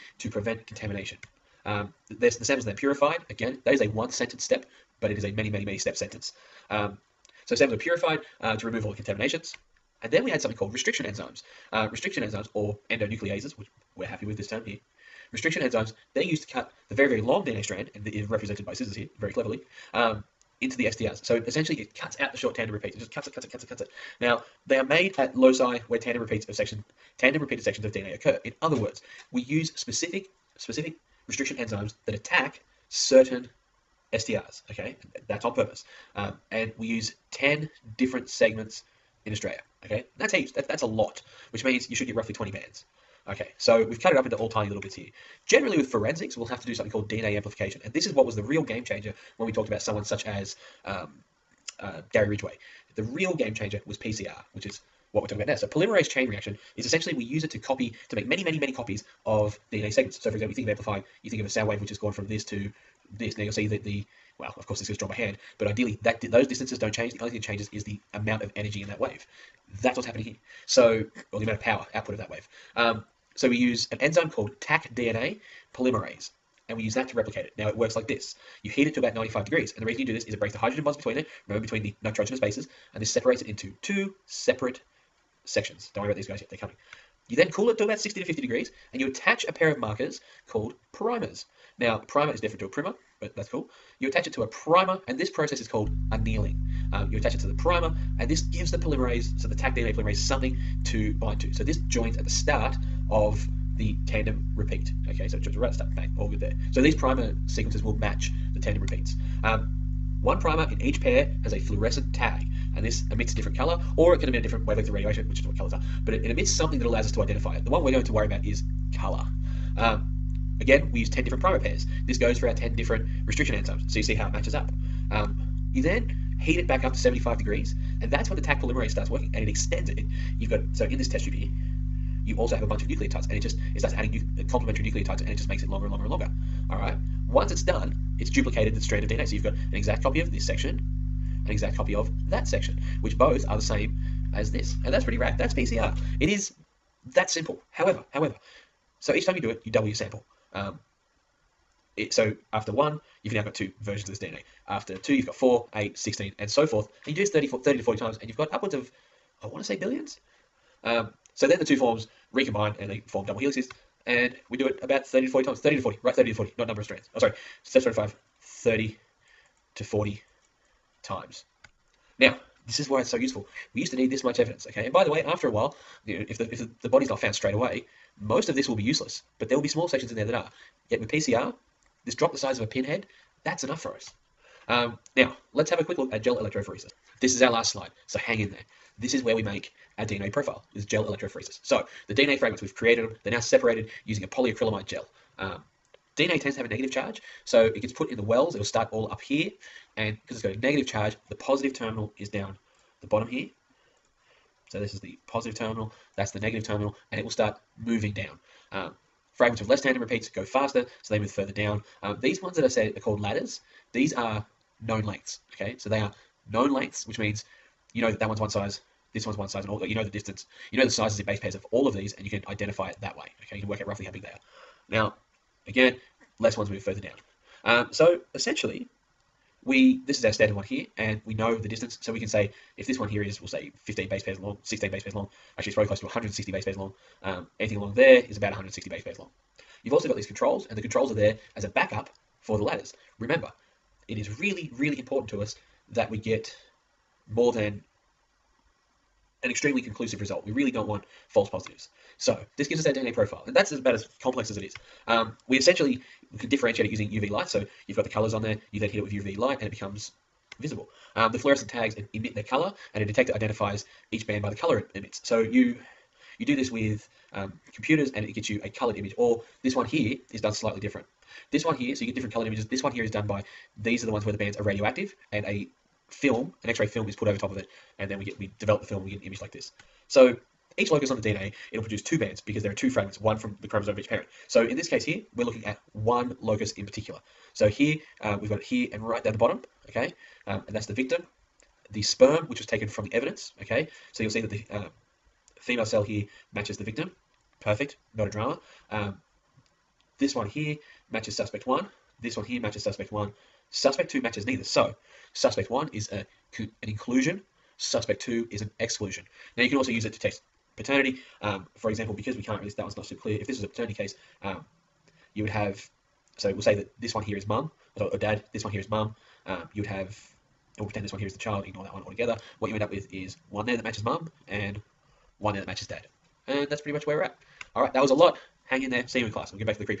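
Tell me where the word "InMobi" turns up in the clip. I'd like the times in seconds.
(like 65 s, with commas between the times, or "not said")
not said.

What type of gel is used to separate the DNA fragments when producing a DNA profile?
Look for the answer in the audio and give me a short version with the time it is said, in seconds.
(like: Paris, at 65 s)
polyacrylamide gel, at 194 s.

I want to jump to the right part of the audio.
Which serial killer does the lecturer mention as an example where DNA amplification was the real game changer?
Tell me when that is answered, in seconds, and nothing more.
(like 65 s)
52 s.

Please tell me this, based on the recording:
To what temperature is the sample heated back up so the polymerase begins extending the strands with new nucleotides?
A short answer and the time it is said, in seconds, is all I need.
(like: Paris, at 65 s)
75 degrees, at 126 s.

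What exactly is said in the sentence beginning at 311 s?
Um, for example, because we can't really, that one's not super clear.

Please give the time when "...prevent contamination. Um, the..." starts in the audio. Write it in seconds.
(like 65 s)
0 s.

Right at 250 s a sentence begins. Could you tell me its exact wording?
We really don't want false positives.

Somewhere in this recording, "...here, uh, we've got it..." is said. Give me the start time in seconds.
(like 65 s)
287 s.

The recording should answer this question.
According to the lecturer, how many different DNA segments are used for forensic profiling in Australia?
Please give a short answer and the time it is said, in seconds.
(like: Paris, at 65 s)
10, at 36 s.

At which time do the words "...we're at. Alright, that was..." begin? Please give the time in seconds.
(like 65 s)
327 s.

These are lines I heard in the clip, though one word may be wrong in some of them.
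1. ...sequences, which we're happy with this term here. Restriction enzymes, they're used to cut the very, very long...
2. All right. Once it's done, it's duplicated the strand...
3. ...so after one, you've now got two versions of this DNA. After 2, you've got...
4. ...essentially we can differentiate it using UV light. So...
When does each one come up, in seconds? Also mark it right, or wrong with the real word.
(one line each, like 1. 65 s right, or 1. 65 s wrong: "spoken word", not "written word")
1. 12 s wrong: "endonucleases", not "sequences"
2. 136 s right
3. 152 s right
4. 255 s right.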